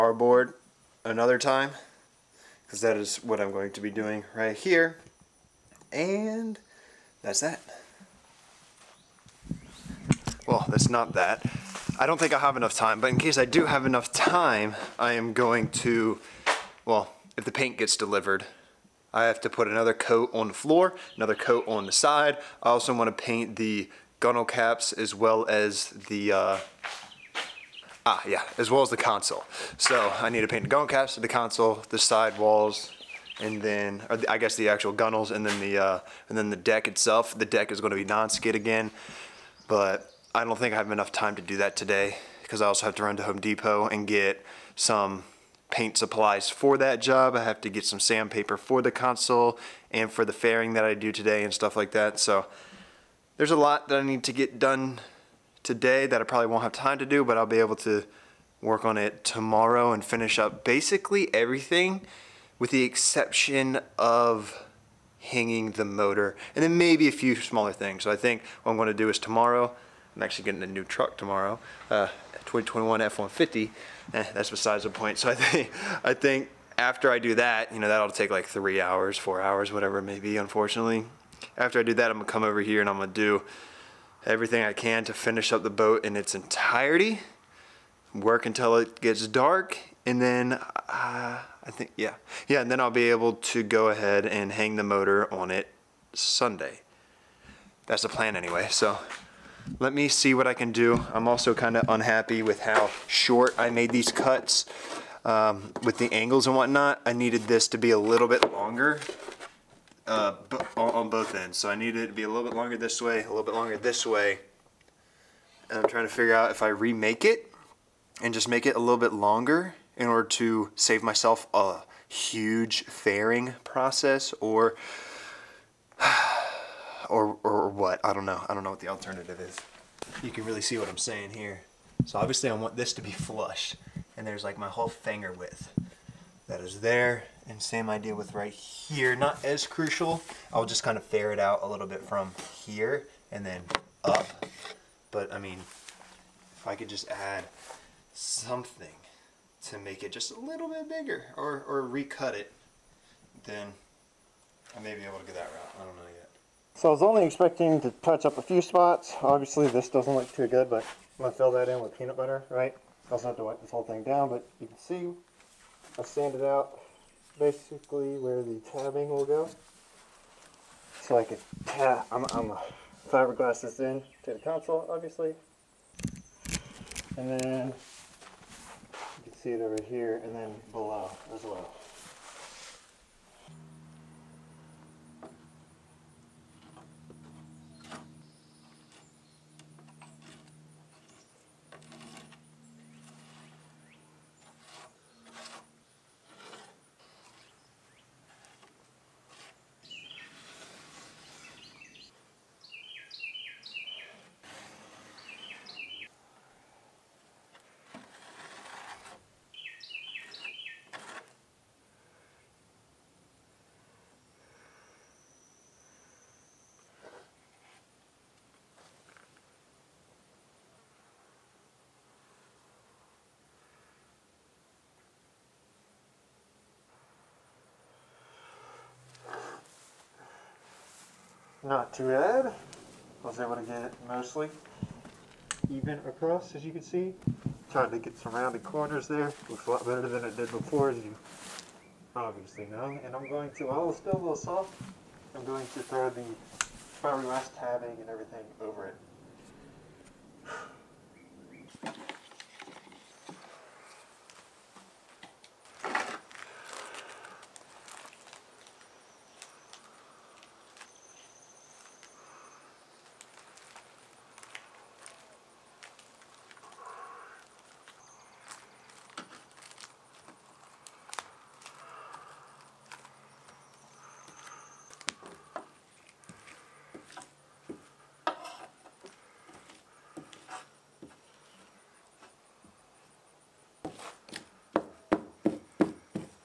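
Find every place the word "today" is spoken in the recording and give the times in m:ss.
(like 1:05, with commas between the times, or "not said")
0:41, 0:51, 0:55.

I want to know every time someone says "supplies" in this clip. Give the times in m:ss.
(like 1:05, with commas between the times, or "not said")
0:45.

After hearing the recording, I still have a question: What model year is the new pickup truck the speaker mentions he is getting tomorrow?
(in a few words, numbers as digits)
2021.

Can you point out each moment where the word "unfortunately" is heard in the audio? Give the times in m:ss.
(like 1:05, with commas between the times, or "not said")
1:20.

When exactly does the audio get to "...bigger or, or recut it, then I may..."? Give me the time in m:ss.
2:30.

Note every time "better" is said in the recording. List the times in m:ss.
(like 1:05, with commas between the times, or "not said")
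3:59.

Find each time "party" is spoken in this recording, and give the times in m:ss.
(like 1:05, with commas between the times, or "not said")
not said.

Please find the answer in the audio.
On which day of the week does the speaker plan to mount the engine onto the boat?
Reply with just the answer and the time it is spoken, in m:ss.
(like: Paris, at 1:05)
Sunday, at 1:36.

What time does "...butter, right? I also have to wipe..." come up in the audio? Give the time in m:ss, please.
2:42.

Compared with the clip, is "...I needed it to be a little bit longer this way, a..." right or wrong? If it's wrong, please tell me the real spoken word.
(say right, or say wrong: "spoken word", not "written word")
right.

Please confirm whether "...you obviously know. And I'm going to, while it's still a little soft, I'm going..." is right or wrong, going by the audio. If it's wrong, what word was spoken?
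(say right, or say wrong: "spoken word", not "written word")
right.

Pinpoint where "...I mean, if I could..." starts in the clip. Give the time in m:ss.
2:25.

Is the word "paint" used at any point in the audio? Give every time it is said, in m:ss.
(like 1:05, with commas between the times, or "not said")
0:17, 0:23, 0:30, 0:45.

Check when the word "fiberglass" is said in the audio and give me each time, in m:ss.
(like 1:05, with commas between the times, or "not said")
2:53, 4:07.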